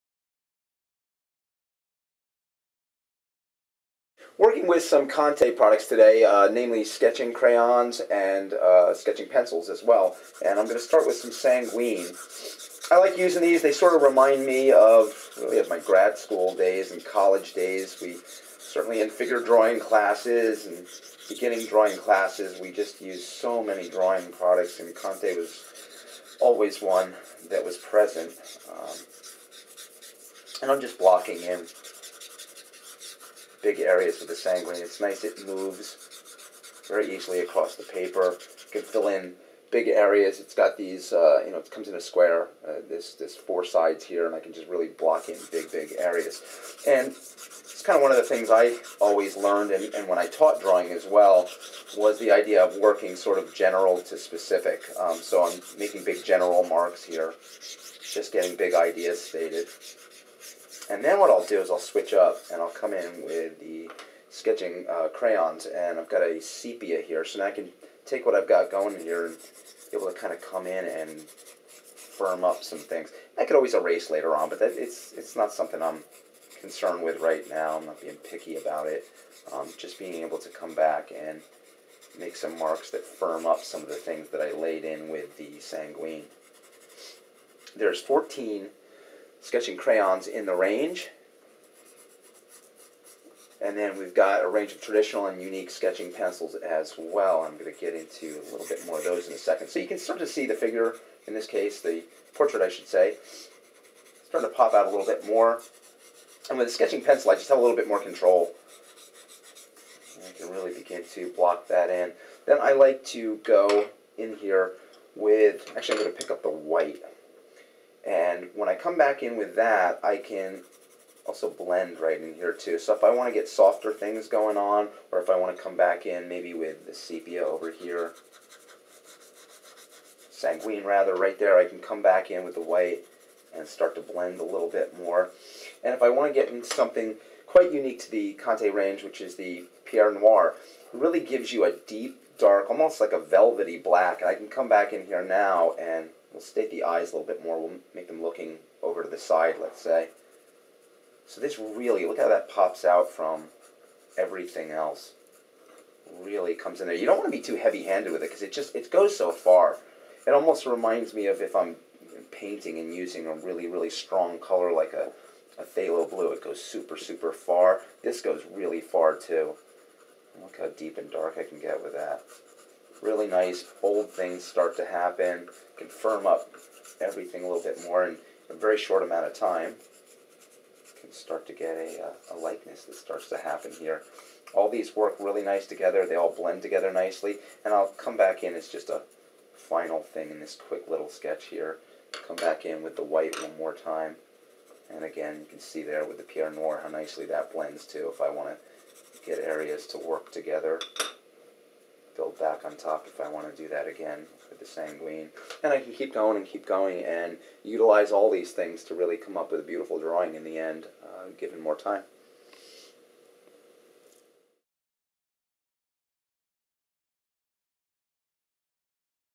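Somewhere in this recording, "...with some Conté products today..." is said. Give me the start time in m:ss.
0:04.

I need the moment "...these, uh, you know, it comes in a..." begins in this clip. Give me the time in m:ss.
0:40.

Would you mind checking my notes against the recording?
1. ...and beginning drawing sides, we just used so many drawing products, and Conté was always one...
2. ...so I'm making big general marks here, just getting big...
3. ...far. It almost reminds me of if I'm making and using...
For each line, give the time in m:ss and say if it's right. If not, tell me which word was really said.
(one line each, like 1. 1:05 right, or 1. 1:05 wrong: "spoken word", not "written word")
1. 0:20 wrong: "classes", not "sides"
2. 0:55 right
3. 2:39 wrong: "painting", not "making".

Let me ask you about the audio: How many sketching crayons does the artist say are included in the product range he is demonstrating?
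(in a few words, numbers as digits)
14.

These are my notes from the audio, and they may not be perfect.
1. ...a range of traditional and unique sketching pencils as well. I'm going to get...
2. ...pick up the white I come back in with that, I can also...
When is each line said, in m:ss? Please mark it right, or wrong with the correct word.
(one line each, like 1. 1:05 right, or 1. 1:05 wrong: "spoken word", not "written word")
1. 1:34 right
2. 1:56 right.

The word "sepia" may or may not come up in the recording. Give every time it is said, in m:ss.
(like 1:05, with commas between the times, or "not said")
1:06, 2:06.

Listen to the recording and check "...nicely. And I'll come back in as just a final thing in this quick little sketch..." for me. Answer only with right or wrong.
right.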